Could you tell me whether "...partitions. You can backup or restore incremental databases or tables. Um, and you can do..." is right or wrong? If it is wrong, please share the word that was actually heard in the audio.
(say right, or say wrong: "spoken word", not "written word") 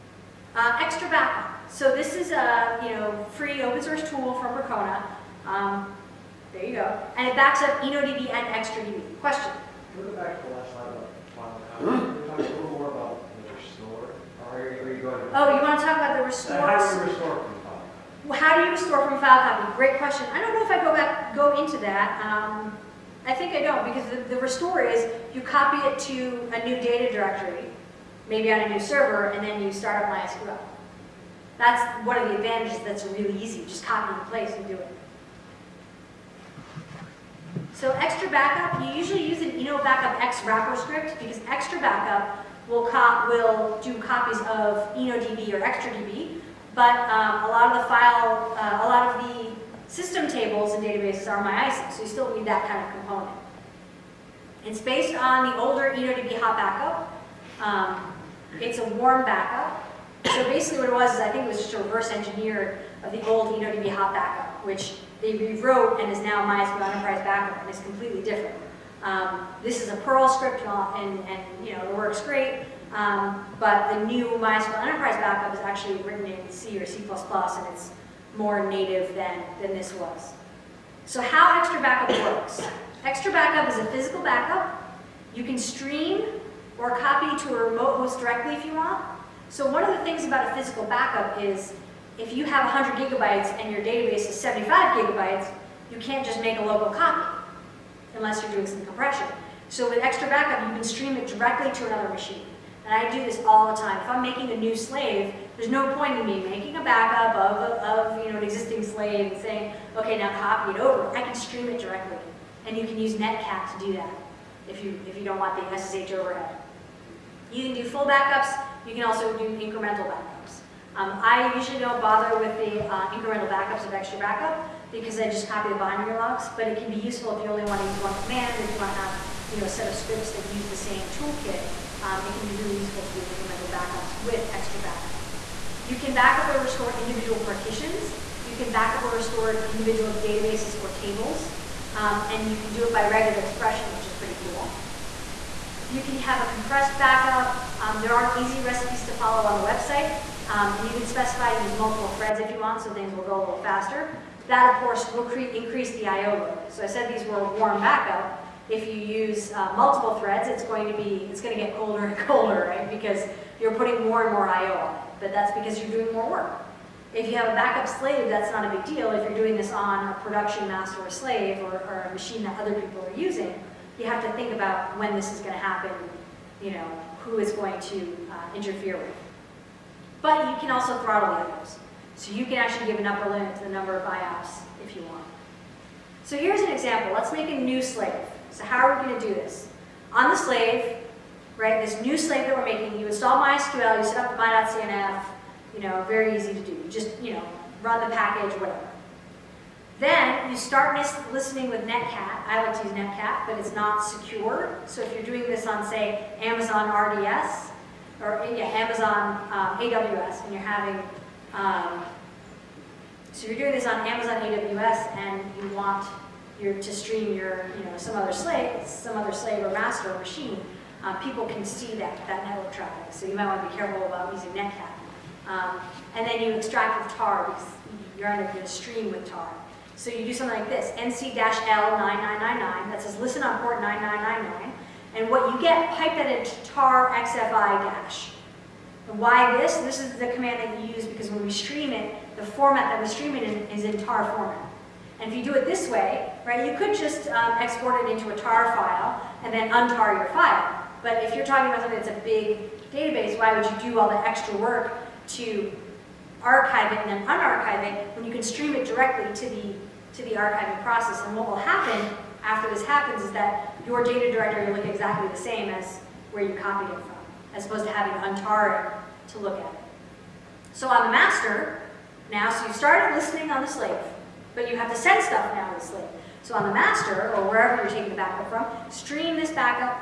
wrong: "individual", not "incremental".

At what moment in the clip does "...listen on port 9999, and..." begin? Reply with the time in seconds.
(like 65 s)
233 s.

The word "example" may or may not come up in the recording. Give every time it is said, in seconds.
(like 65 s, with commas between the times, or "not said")
186 s.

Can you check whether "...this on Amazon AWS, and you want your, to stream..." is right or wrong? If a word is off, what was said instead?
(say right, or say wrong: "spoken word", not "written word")
right.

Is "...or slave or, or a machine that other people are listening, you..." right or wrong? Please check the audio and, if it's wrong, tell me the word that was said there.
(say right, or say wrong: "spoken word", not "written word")
wrong: "using", not "listening".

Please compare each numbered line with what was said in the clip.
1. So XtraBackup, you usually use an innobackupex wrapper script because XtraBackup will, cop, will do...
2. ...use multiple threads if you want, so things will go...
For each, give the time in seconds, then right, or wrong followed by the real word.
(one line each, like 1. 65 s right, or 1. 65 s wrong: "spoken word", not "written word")
1. 37 s right
2. 151 s right.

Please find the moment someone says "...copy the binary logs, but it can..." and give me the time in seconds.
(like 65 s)
125 s.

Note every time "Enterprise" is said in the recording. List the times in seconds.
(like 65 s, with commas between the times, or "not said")
66 s, 74 s.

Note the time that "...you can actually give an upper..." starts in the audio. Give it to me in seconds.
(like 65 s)
182 s.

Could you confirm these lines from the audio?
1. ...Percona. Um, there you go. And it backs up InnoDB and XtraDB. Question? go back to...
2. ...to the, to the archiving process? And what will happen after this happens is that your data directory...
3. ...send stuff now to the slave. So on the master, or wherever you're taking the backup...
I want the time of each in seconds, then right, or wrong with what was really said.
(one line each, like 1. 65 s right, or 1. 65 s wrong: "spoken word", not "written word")
1. 4 s right
2. 259 s right
3. 274 s right.